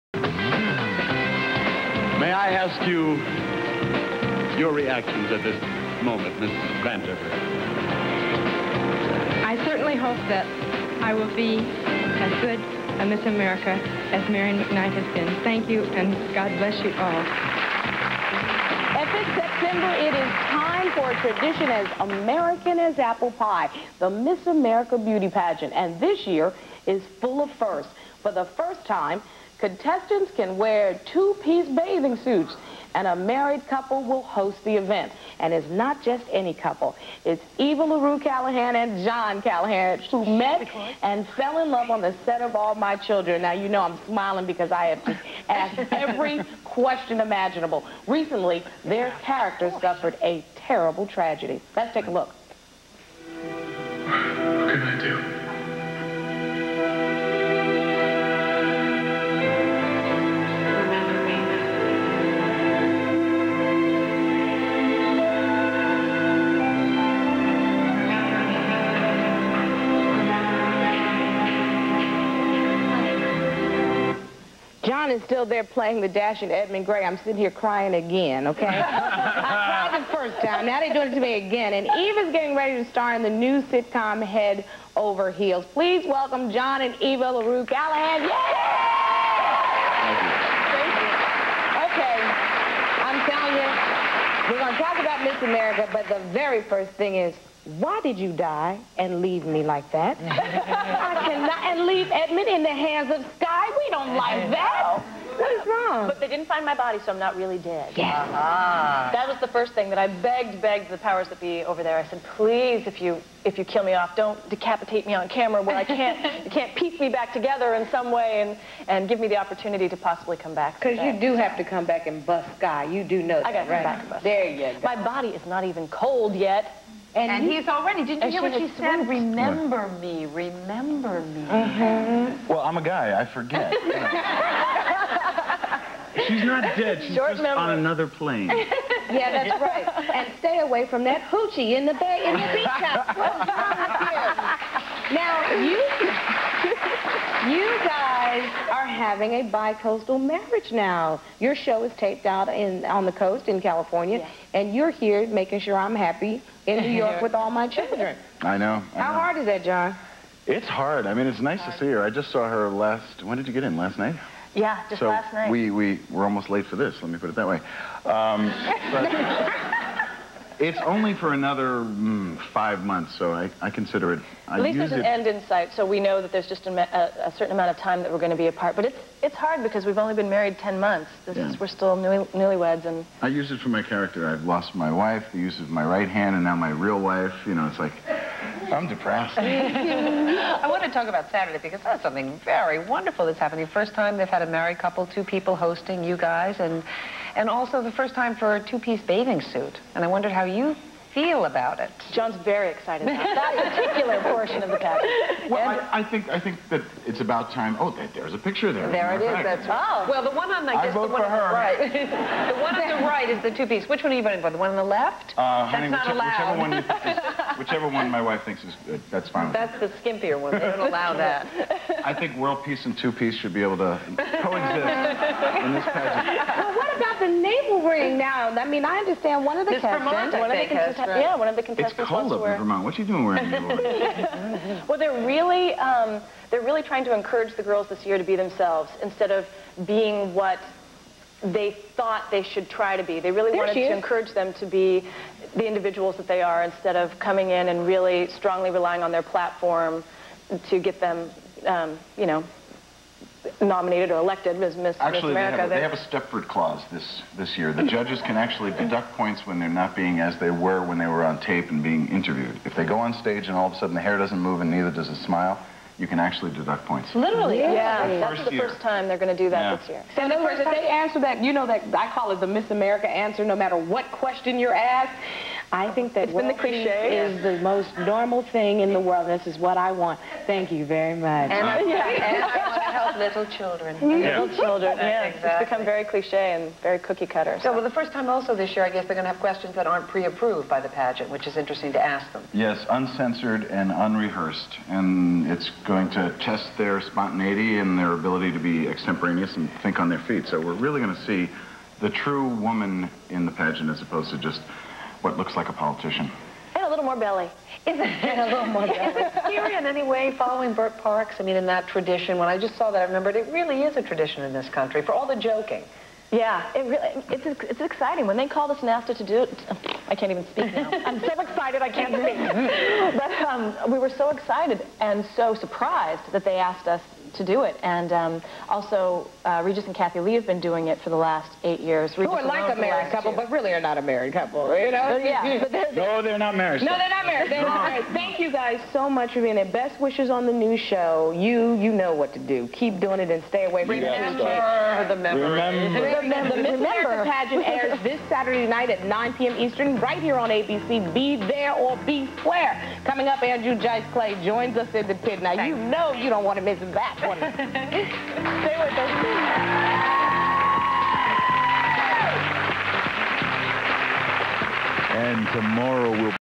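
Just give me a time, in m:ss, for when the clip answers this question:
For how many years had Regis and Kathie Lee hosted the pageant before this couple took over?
5:31.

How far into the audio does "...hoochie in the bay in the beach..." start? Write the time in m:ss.
2:21.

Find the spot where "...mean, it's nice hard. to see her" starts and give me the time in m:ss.
2:41.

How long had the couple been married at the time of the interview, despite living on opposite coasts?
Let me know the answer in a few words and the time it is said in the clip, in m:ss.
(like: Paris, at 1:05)
10 months, at 3:00.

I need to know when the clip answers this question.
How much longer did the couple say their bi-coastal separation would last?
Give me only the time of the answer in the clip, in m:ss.
2:52.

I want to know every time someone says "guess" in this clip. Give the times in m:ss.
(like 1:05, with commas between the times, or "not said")
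3:30, 4:48.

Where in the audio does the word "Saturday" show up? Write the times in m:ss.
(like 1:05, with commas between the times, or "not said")
3:11, 5:48.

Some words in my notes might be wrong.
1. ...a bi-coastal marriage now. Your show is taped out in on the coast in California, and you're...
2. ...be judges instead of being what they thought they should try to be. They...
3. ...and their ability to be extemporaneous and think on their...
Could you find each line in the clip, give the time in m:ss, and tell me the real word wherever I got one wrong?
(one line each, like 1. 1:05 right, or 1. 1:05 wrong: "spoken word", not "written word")
1. 2:29 right
2. 3:58 wrong: "themselves", not "judges"
3. 4:57 right.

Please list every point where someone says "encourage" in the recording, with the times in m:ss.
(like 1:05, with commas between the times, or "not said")
3:57, 4:03.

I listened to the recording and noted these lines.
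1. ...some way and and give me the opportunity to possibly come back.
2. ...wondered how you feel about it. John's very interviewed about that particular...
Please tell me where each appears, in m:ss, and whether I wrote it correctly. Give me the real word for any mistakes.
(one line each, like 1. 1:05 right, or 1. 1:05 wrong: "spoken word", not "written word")
1. 1:57 right
2. 3:20 wrong: "excited", not "interviewed".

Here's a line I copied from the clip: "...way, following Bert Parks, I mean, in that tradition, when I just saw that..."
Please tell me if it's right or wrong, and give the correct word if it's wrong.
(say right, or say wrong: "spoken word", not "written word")
right.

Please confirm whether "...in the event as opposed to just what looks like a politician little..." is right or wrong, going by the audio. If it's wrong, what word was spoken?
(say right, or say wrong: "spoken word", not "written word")
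wrong: "pageant", not "event".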